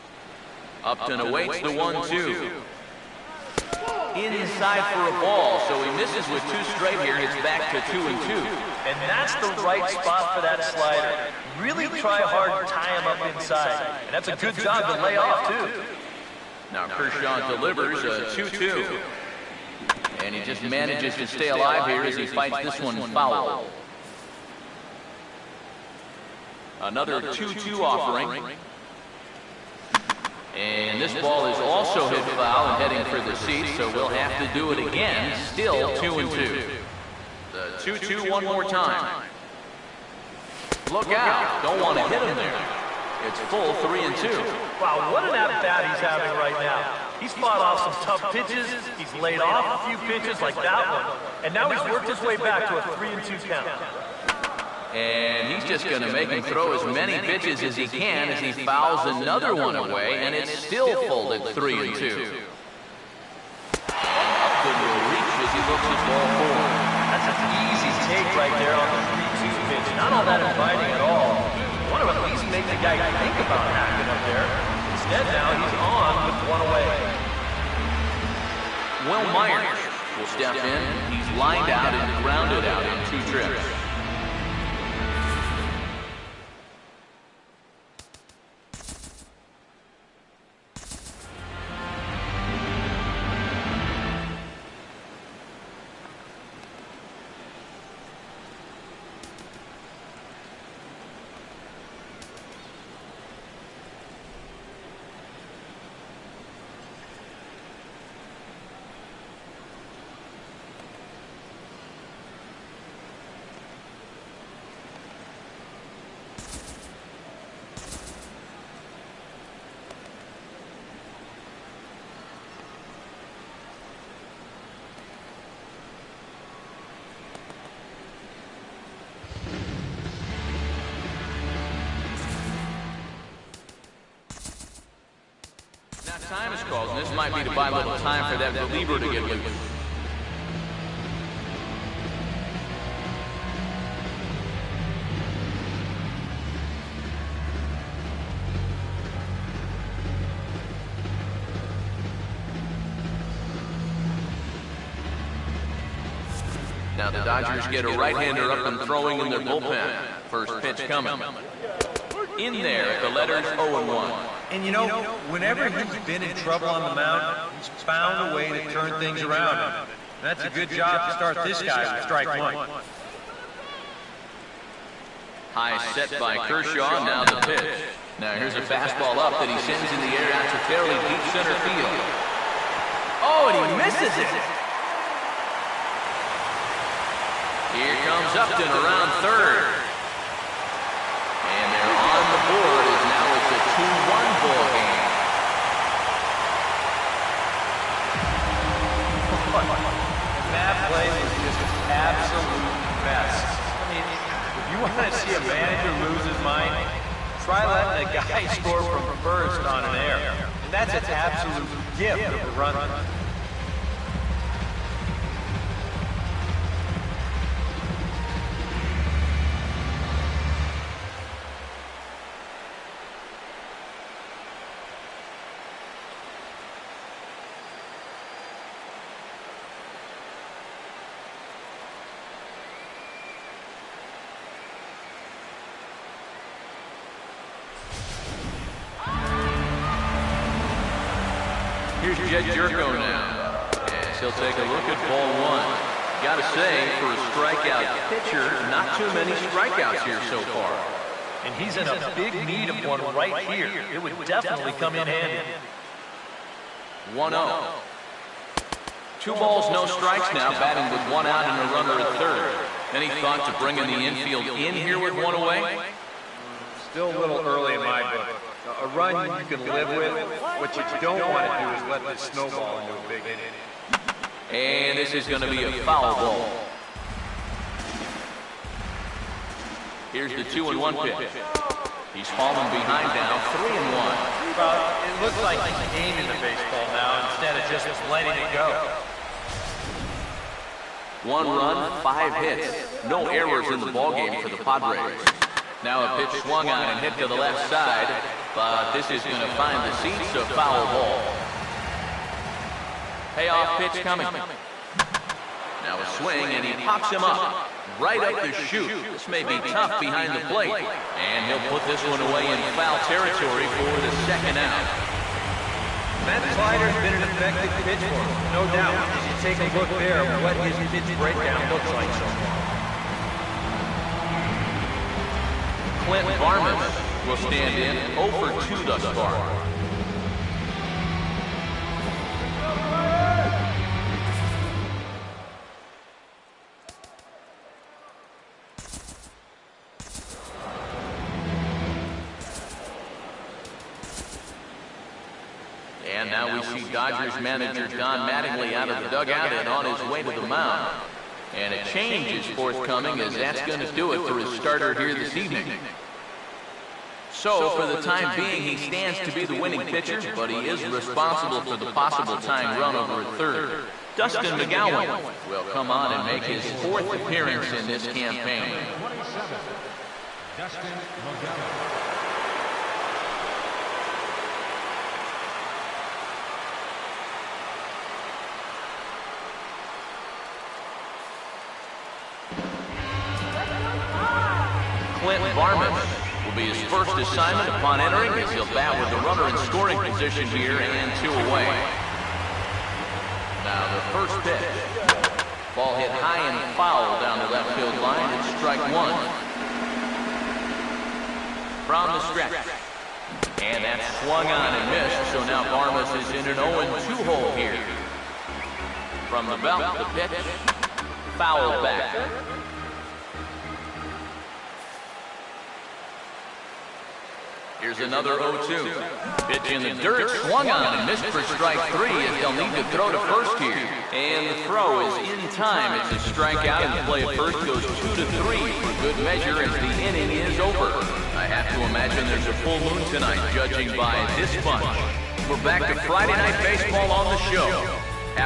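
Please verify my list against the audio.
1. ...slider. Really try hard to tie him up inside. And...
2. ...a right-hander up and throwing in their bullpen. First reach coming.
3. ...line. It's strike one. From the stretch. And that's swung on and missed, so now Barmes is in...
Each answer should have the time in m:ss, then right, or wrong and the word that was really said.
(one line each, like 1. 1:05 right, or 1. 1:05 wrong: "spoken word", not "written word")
1. 0:10 right
2. 2:37 wrong: "pitch", not "reach"
3. 6:38 right.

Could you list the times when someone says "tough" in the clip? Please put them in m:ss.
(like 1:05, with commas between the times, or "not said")
0:47, 5:09.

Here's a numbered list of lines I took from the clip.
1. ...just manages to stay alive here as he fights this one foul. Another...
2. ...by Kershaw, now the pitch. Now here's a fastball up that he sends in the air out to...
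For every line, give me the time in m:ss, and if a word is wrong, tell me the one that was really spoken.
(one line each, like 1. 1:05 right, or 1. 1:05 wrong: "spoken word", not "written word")
1. 0:20 right
2. 2:56 right.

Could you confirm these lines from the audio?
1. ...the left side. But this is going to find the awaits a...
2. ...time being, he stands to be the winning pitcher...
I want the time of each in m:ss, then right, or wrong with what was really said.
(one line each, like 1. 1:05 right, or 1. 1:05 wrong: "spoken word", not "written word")
1. 4:57 wrong: "seats", not "awaits"
2. 5:57 right.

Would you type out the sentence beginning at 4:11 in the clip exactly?
And he's in a big need of one right here.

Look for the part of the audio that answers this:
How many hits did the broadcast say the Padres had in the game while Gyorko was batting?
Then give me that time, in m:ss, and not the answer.
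4:52.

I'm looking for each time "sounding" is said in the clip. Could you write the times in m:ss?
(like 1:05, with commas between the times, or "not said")
not said.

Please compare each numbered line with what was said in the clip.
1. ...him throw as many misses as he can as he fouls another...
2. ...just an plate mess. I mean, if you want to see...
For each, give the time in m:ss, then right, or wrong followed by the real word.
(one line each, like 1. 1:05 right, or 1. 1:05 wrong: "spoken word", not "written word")
1. 0:56 wrong: "pitches", not "misses"
2. 3:21 wrong: "absolute", not "plate".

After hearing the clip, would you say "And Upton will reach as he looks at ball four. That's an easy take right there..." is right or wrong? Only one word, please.
right.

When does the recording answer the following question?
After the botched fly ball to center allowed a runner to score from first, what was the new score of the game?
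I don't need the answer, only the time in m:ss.
3:13.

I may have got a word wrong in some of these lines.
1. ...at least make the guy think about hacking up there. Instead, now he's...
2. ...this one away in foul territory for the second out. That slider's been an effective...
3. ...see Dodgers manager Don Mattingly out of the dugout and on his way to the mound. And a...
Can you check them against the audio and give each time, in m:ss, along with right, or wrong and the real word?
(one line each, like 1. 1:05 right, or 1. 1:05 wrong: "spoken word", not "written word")
1. 1:12 right
2. 5:11 right
3. 5:46 right.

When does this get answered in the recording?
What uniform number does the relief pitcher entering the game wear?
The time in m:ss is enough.
6:08.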